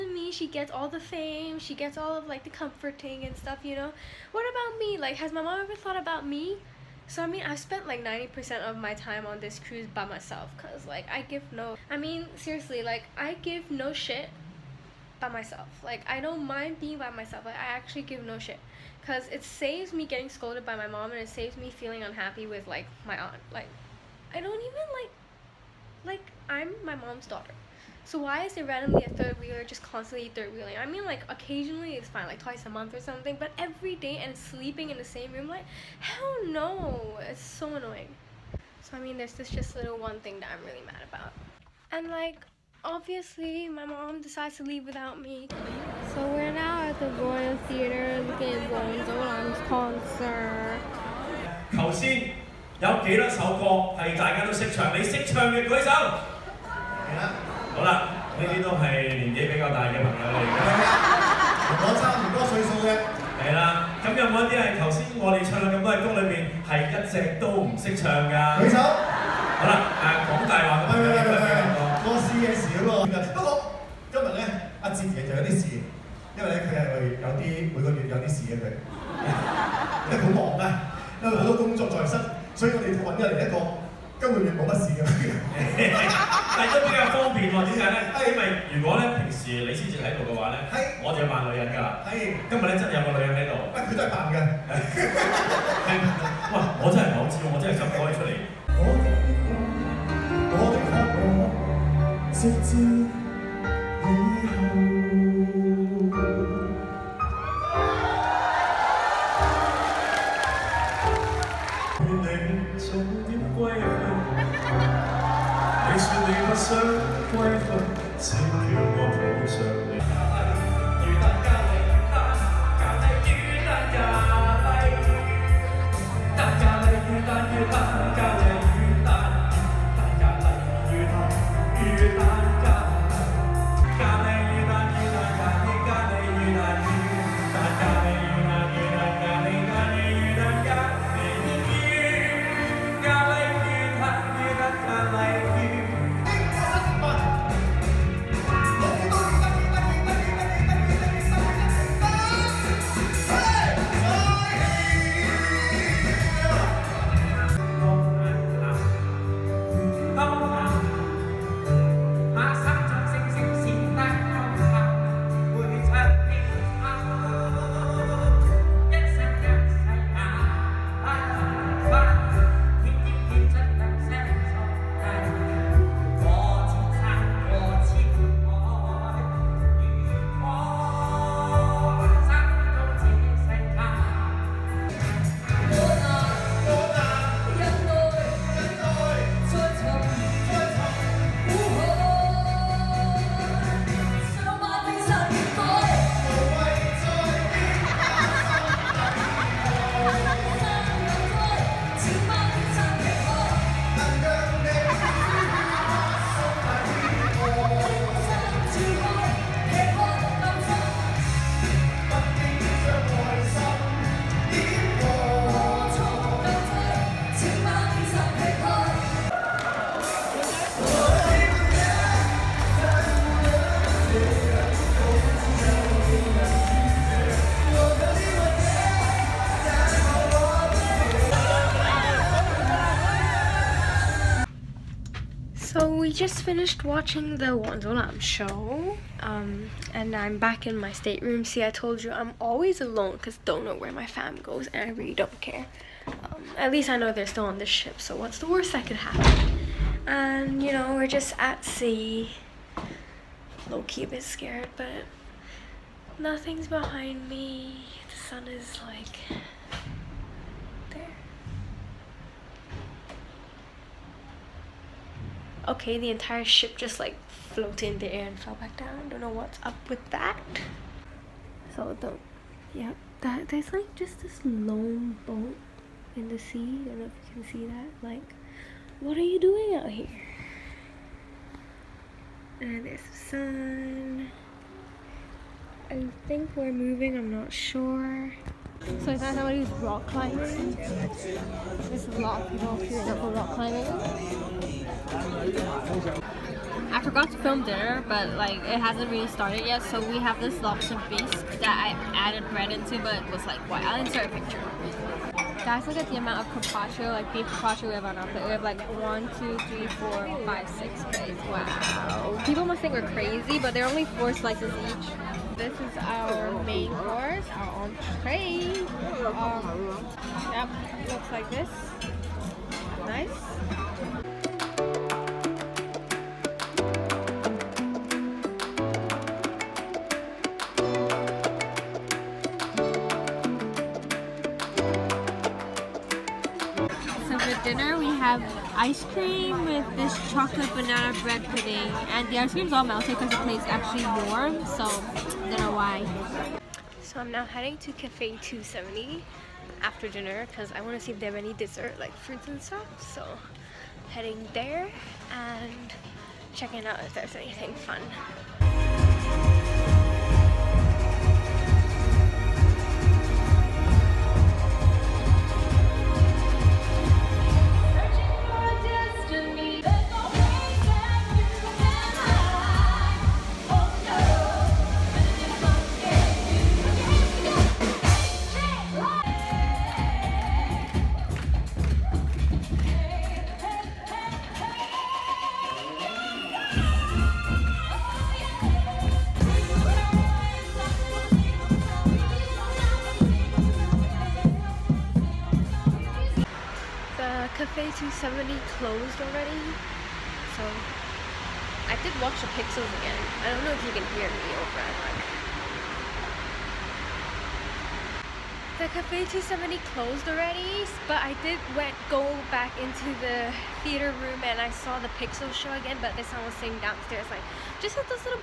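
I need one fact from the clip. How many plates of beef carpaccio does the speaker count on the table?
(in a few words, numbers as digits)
6.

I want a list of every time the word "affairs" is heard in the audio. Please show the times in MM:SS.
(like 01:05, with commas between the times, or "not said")
not said.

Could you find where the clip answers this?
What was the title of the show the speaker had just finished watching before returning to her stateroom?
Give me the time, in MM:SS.
03:57.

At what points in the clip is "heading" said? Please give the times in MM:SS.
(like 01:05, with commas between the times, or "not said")
05:47, 05:54.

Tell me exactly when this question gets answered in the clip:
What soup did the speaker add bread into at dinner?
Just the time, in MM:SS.
05:00.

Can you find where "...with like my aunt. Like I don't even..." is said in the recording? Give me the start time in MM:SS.
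00:22.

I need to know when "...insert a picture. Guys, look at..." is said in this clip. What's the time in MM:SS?
05:04.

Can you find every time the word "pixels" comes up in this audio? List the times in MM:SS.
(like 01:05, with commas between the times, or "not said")
06:42, 06:55.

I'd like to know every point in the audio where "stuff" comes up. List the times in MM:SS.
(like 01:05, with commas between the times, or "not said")
00:03, 05:52.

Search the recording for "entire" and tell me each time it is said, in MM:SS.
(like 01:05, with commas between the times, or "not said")
04:26.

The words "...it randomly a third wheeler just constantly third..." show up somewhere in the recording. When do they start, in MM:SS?
00:28.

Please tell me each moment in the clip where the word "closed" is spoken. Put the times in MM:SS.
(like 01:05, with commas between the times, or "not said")
06:38, 06:49.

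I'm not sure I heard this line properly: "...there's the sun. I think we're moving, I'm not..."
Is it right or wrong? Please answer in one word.
right.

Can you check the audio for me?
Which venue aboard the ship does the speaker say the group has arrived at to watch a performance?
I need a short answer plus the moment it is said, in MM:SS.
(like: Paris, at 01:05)
Royal Theatre, at 00:47.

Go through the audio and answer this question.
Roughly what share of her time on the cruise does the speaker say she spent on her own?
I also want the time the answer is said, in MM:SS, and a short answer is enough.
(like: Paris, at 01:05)
90%, at 00:08.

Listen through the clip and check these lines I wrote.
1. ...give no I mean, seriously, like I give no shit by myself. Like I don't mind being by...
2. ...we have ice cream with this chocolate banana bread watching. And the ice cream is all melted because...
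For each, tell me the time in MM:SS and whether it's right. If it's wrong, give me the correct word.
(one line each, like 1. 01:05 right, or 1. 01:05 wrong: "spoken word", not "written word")
1. 00:11 right
2. 05:37 wrong: "pudding", not "watching".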